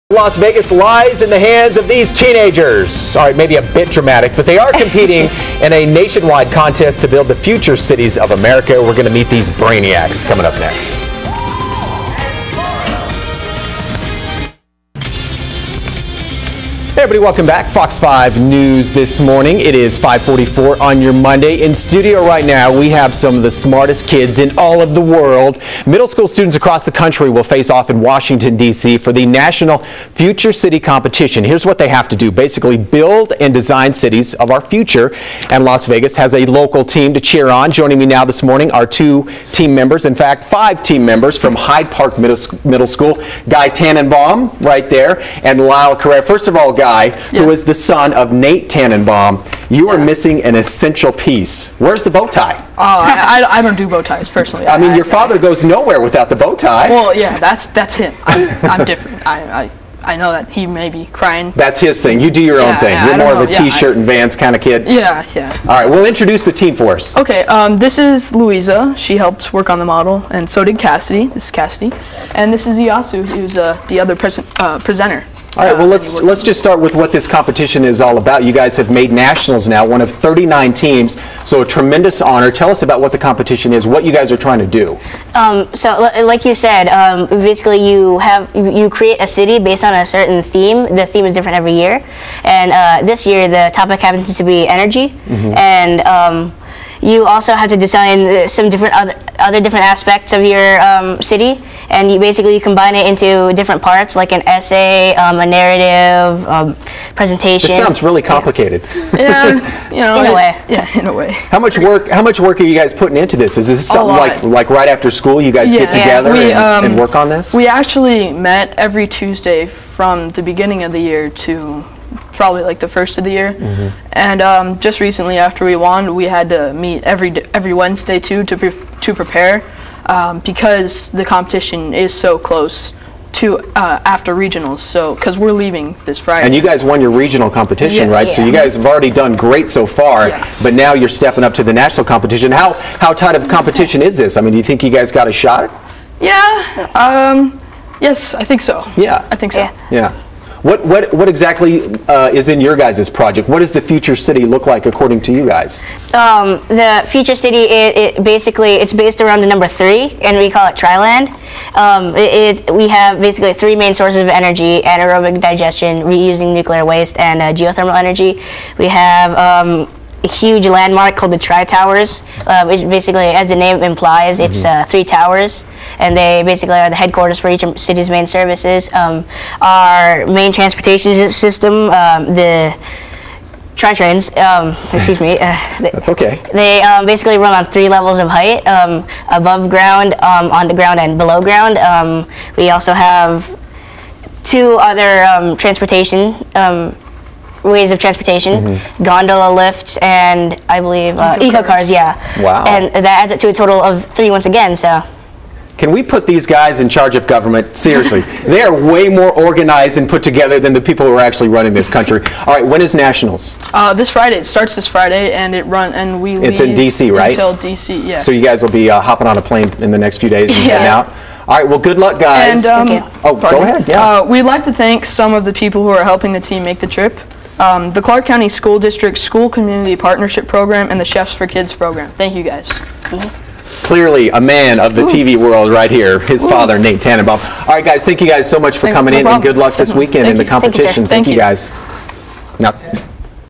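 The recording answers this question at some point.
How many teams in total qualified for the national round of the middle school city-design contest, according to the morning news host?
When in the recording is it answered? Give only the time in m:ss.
1:20.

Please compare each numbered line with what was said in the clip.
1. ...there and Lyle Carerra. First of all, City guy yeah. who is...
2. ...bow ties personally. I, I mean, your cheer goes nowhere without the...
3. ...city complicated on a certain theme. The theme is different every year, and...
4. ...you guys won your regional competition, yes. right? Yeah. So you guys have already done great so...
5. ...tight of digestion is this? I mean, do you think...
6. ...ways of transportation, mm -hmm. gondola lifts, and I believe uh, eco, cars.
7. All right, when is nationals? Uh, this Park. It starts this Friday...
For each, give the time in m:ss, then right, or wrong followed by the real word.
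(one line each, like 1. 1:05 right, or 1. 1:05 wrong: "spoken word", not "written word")
1. 0:44 wrong: "Guy", not "City"
2. 0:53 wrong: "father", not "cheer"
3. 1:29 wrong: "based", not "complicated"
4. 2:16 right
5. 2:23 wrong: "competition", not "digestion"
6. 3:17 right
7. 3:32 wrong: "Friday", not "Park".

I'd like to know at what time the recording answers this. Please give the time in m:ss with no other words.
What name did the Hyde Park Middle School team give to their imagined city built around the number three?
2:40.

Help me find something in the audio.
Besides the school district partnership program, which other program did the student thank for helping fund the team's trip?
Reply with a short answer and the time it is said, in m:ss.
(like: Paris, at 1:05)
Chefs for Kids Program, at 3:51.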